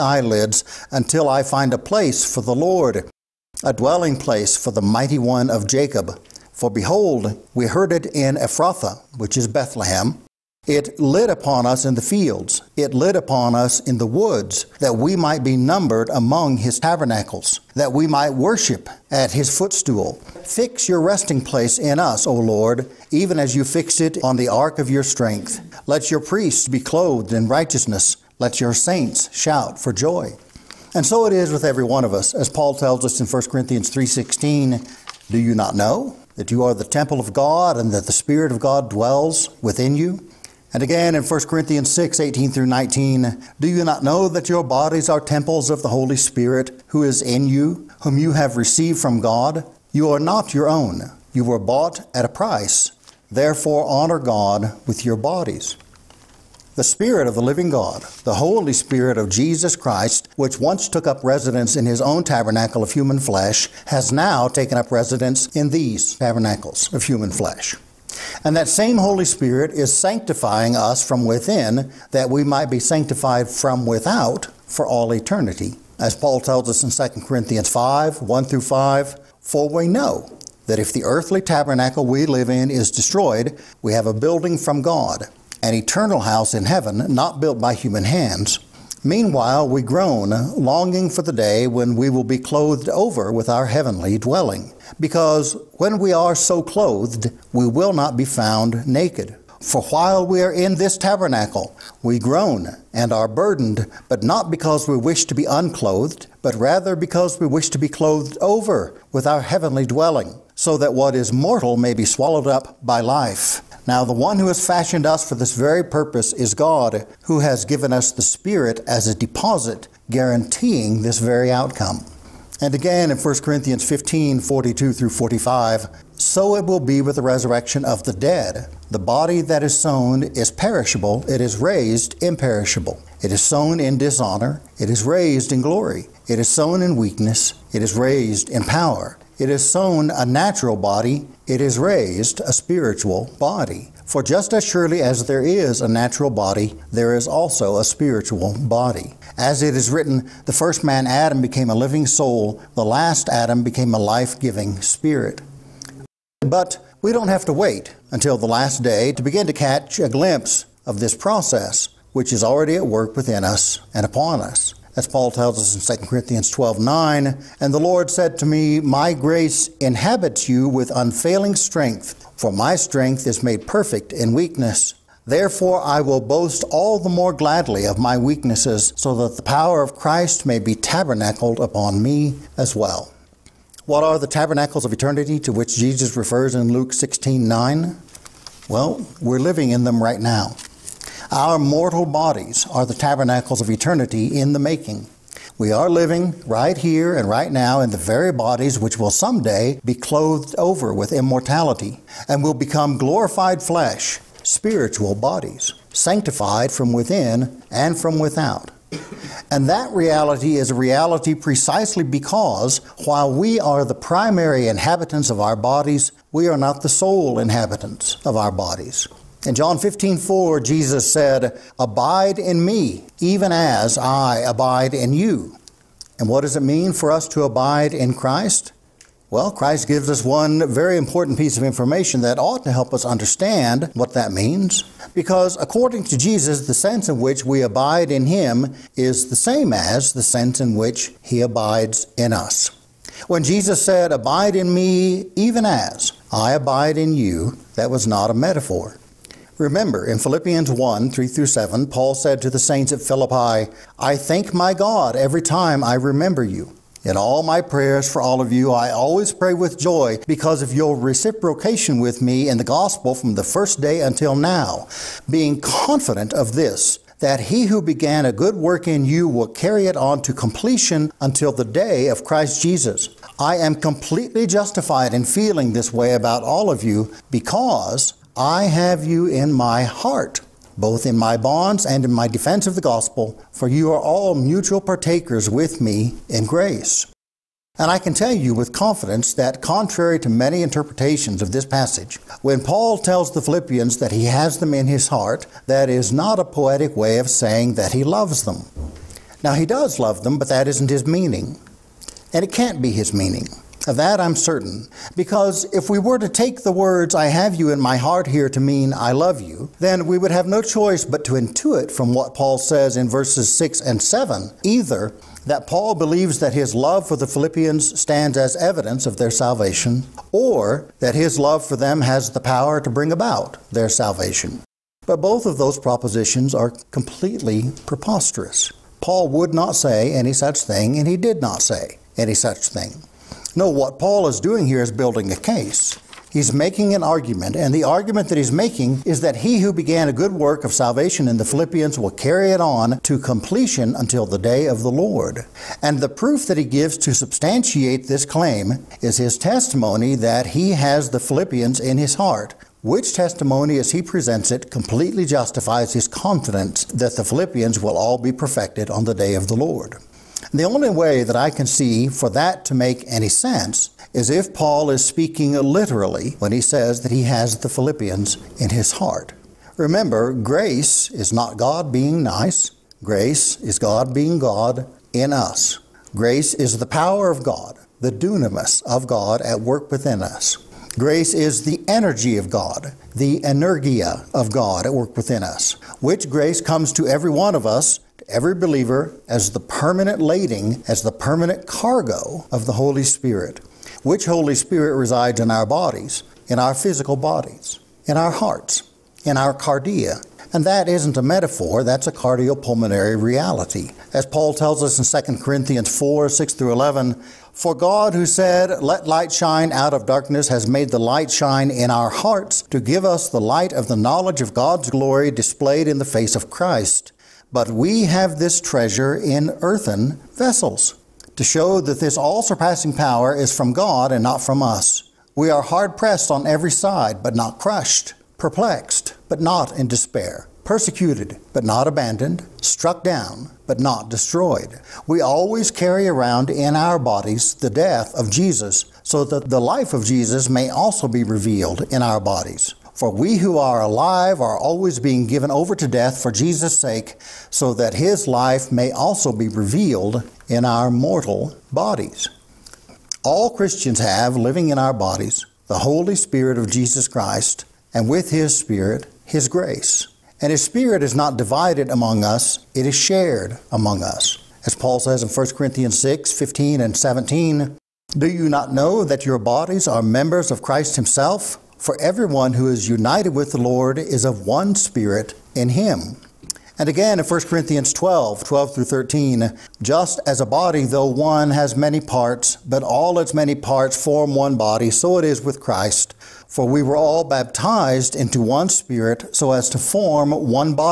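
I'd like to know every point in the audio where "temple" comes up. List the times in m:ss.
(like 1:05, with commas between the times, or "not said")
0:36, 0:45.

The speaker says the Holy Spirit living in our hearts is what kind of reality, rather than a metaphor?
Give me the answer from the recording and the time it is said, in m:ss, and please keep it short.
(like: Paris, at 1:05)
cardiopulmonary, at 6:42.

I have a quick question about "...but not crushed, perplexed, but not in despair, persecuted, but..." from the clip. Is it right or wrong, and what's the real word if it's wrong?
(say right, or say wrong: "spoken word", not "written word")
right.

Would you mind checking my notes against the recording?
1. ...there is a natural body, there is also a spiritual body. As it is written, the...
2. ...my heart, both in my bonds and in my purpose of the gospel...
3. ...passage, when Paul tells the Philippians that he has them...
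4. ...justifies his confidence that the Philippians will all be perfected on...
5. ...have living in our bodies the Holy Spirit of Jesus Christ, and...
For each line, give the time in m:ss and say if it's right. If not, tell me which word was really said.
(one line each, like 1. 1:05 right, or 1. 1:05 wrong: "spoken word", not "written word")
1. 2:25 right
2. 4:39 wrong: "defense", not "purpose"
3. 4:51 right
4. 5:55 right
5. 7:33 right.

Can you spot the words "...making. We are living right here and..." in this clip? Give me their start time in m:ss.
3:14.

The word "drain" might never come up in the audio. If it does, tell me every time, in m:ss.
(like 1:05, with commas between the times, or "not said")
not said.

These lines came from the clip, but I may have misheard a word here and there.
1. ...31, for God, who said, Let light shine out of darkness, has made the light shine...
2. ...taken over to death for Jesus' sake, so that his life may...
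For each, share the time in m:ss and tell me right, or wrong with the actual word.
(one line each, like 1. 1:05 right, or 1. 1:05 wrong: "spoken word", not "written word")
1. 6:46 wrong: "11", not "31"
2. 7:25 wrong: "given", not "taken".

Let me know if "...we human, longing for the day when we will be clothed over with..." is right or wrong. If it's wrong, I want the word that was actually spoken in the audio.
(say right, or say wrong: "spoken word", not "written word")
wrong: "groan", not "human".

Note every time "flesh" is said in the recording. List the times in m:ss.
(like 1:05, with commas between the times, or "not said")
1:03, 1:07, 3:23.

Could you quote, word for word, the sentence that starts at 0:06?
For behold, we heard it in Ephrathah, which is Bethlehem, it lit upon us in the fields.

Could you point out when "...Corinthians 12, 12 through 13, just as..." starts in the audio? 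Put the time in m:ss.
7:57.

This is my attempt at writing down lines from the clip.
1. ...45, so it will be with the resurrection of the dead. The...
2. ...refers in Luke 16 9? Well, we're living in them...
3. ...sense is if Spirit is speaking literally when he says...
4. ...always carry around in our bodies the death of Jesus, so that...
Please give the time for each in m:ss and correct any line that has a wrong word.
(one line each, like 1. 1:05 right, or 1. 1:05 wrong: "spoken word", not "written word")
1. 2:05 right
2. 3:06 right
3. 6:03 wrong: "Paul", not "Spirit"
4. 7:15 right.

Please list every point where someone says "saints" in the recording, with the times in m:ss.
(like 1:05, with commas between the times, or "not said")
0:28, 4:12.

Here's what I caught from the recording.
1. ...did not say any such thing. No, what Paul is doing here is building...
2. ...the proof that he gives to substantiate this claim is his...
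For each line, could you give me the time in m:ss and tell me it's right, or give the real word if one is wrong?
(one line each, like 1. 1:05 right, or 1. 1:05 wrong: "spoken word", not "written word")
1. 5:31 right
2. 5:45 right.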